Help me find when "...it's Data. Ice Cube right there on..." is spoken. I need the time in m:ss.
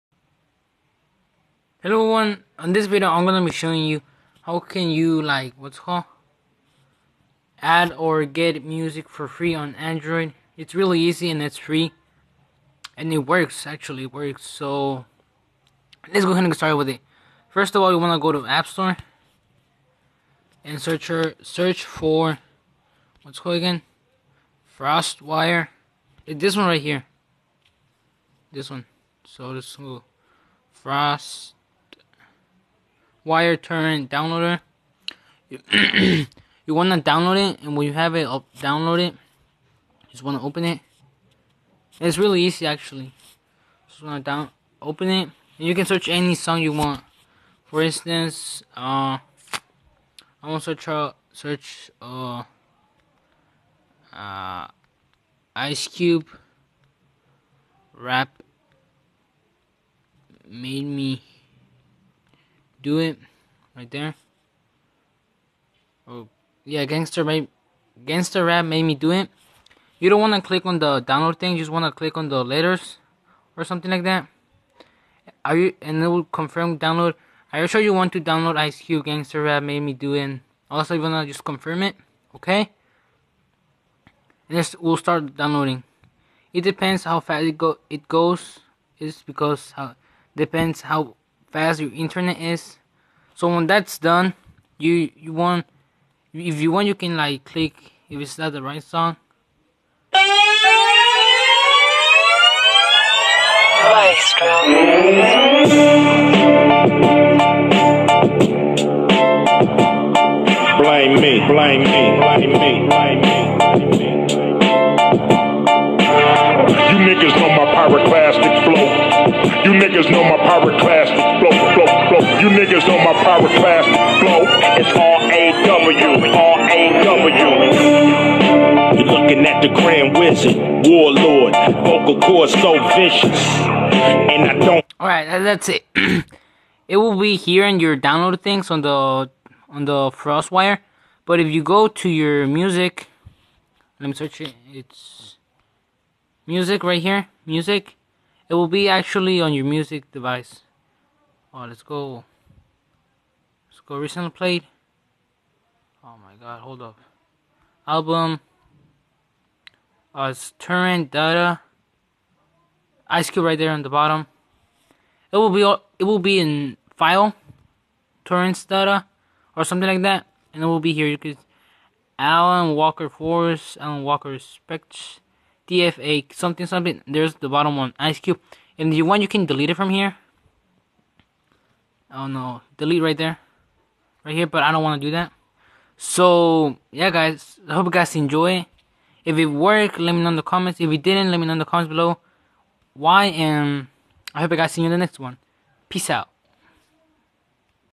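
2:40.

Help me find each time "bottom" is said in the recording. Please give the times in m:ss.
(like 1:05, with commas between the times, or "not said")
2:43, 2:57.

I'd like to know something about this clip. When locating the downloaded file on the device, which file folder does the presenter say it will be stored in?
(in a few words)
Torrents data.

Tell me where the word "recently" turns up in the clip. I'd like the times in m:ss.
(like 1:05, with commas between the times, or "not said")
2:33.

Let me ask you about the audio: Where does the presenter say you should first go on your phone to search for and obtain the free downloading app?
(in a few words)
App Store.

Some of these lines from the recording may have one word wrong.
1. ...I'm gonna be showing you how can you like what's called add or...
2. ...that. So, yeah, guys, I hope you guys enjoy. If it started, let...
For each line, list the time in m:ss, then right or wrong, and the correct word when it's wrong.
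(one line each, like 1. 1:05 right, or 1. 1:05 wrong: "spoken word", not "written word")
1. 0:03 right
2. 3:05 wrong: "worked", not "started".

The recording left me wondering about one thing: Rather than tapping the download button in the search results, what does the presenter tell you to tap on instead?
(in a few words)
The letters.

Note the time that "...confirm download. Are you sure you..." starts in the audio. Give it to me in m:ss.
1:16.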